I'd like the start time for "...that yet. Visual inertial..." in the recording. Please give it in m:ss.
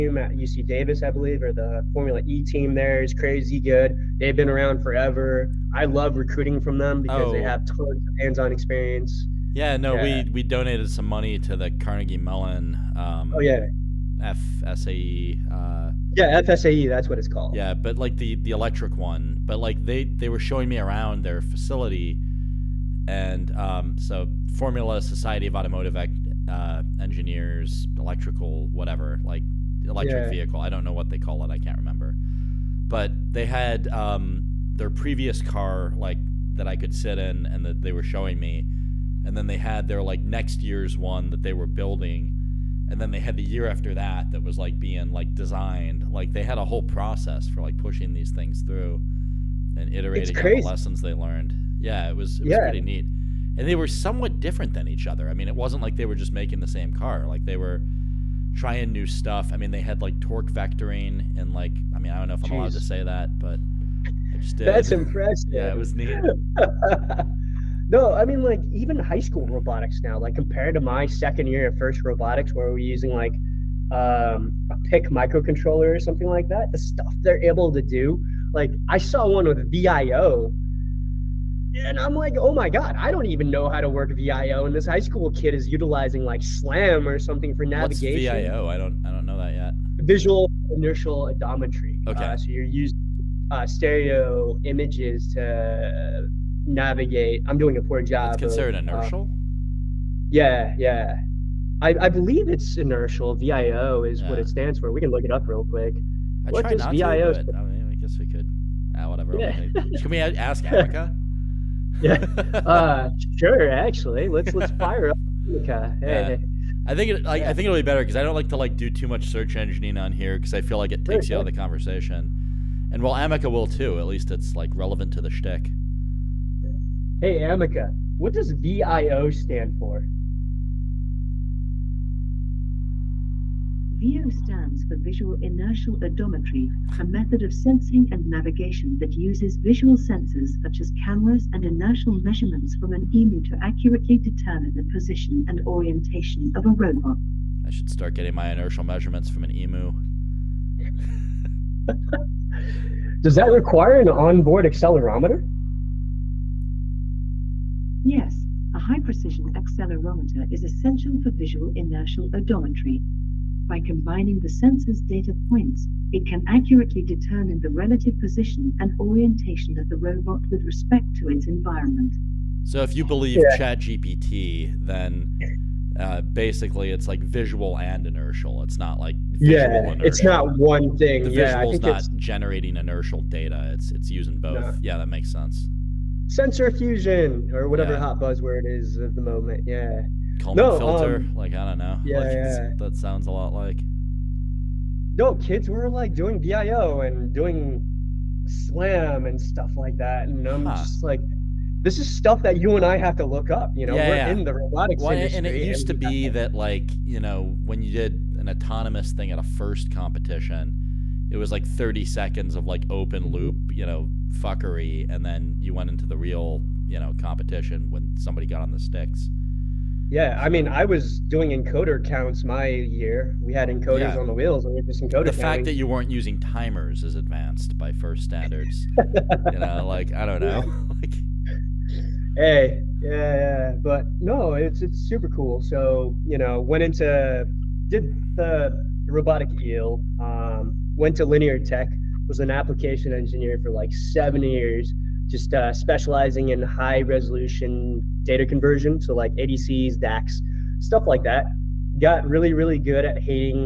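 1:29.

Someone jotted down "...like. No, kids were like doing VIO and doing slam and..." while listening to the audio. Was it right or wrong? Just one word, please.
right.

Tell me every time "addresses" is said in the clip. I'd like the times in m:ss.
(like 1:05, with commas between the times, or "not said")
not said.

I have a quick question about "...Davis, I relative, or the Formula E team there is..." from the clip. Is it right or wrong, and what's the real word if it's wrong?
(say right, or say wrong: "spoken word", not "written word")
wrong: "believe", not "relative".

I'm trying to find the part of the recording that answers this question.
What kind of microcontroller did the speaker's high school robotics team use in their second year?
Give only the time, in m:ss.
1:14.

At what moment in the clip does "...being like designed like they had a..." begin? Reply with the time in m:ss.
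0:44.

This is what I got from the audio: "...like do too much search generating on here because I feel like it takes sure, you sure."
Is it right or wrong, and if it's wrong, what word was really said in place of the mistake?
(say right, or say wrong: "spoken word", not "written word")
wrong: "engineering", not "generating".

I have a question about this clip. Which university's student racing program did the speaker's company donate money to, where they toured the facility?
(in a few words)
Carnegie Mellon.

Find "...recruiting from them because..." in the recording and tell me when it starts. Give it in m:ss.
0:06.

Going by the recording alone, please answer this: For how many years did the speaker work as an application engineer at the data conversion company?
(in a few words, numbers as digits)
7.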